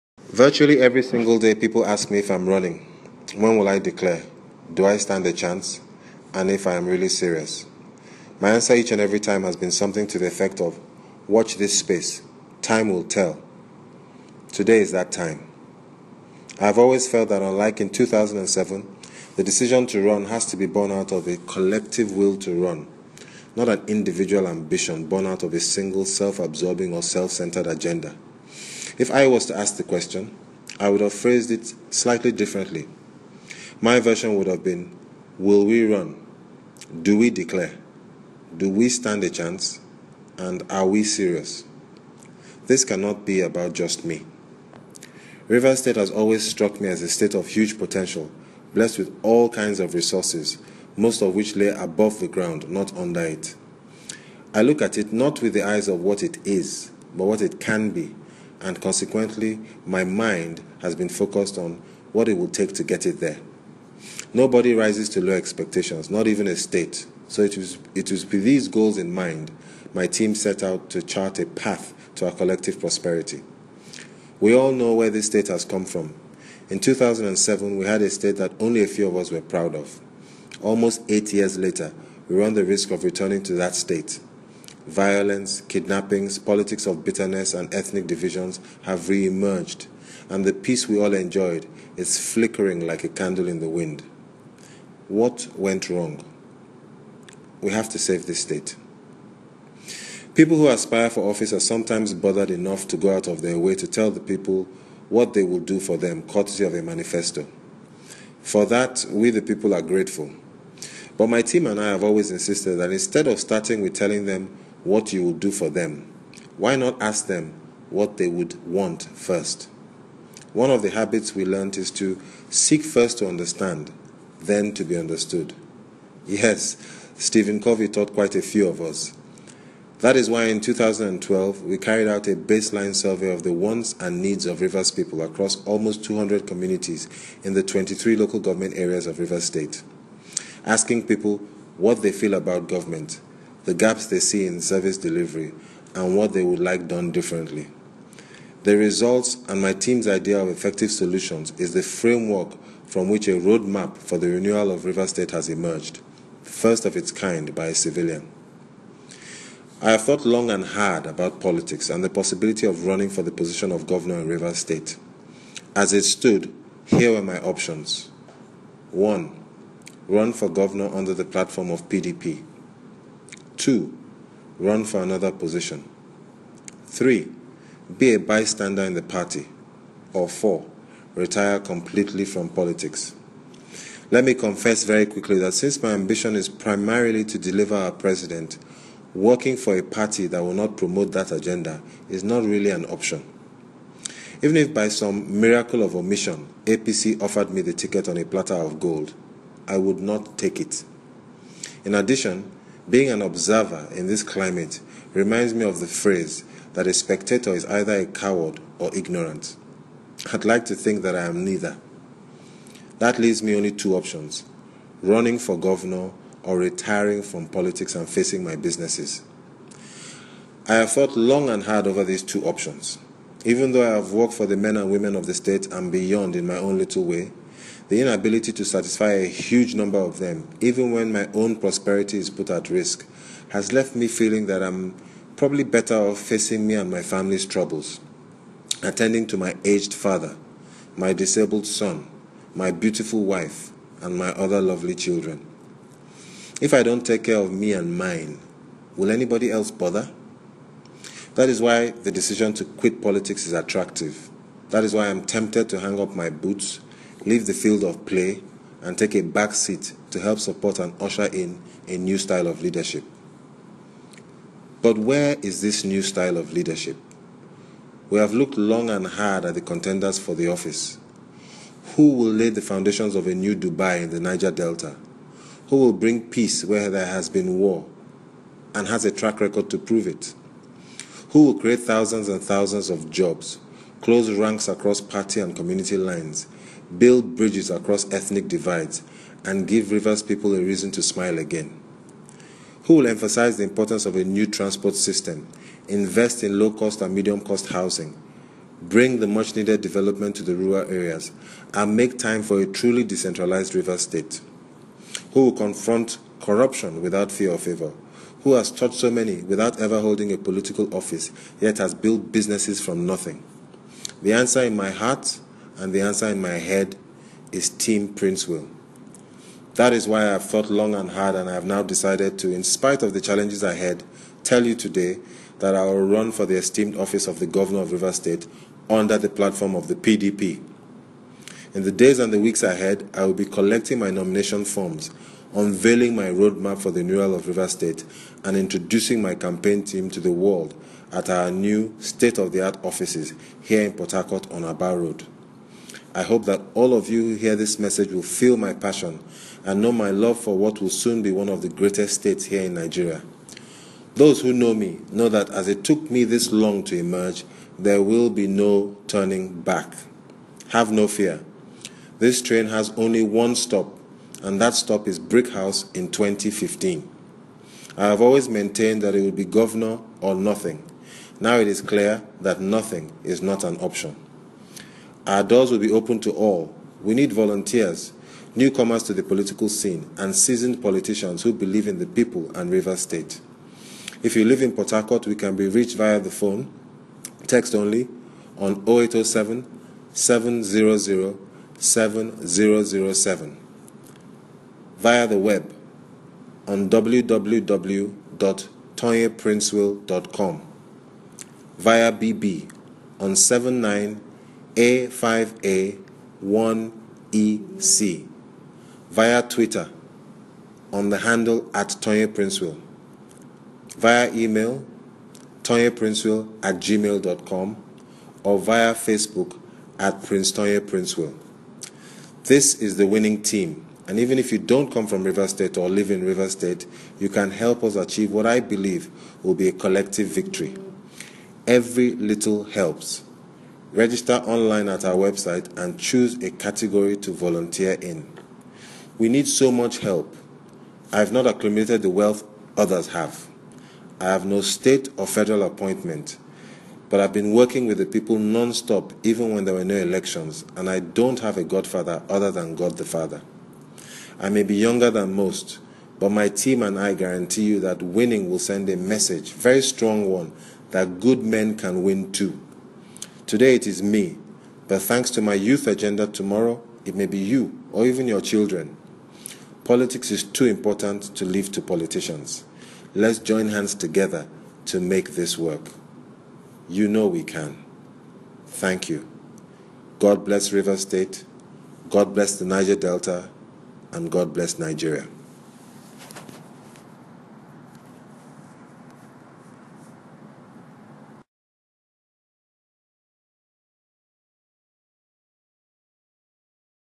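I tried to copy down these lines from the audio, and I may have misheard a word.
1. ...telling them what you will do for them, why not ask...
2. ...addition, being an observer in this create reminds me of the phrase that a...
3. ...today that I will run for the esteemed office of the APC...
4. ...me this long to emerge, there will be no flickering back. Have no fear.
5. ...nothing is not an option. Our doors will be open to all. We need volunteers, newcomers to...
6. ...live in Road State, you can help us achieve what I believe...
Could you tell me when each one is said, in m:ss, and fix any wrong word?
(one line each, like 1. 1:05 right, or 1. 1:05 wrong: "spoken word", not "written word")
1. 1:53 right
2. 3:21 wrong: "climate", not "create"
3. 5:24 wrong: "Governor", not "APC"
4. 5:56 wrong: "turning", not "flickering"
5. 6:12 right
6. 7:05 wrong: "Rivers", not "Road".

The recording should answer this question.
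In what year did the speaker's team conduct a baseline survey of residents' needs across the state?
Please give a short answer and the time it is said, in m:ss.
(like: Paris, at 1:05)
2012, at 2:10.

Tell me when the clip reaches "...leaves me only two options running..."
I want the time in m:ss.
3:33.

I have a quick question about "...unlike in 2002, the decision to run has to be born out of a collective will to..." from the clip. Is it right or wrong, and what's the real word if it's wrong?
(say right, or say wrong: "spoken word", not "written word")
wrong: "2007", not "2002".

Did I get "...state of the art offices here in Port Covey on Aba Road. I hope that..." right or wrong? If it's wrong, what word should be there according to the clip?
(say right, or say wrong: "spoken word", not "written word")
wrong: "Harcourt", not "Covey".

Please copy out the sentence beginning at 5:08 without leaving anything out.
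Who has taught so many without ever holding a political office, yet has built businesses from nothing?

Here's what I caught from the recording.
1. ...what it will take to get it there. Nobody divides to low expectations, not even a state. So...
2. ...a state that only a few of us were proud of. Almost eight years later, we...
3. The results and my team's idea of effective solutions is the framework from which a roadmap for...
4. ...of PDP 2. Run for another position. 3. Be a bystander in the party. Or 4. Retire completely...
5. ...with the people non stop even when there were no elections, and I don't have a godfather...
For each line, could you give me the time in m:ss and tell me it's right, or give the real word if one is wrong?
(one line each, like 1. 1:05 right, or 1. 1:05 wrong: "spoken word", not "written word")
1. 1:02 wrong: "rises", not "divides"
2. 1:18 right
3. 2:28 right
4. 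2:51 right
5. 7:27 right.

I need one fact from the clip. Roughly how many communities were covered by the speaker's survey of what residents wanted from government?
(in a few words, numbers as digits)
200.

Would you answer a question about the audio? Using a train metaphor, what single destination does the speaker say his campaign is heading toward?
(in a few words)
Brickhouse.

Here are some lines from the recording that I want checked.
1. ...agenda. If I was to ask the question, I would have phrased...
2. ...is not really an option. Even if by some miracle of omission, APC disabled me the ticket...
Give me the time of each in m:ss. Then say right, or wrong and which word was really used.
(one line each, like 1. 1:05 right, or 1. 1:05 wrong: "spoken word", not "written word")
1. 0:27 right
2. 3:12 wrong: "offered", not "disabled".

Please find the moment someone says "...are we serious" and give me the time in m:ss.
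0:40.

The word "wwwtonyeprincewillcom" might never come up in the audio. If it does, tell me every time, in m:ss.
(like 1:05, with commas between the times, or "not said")
6:36.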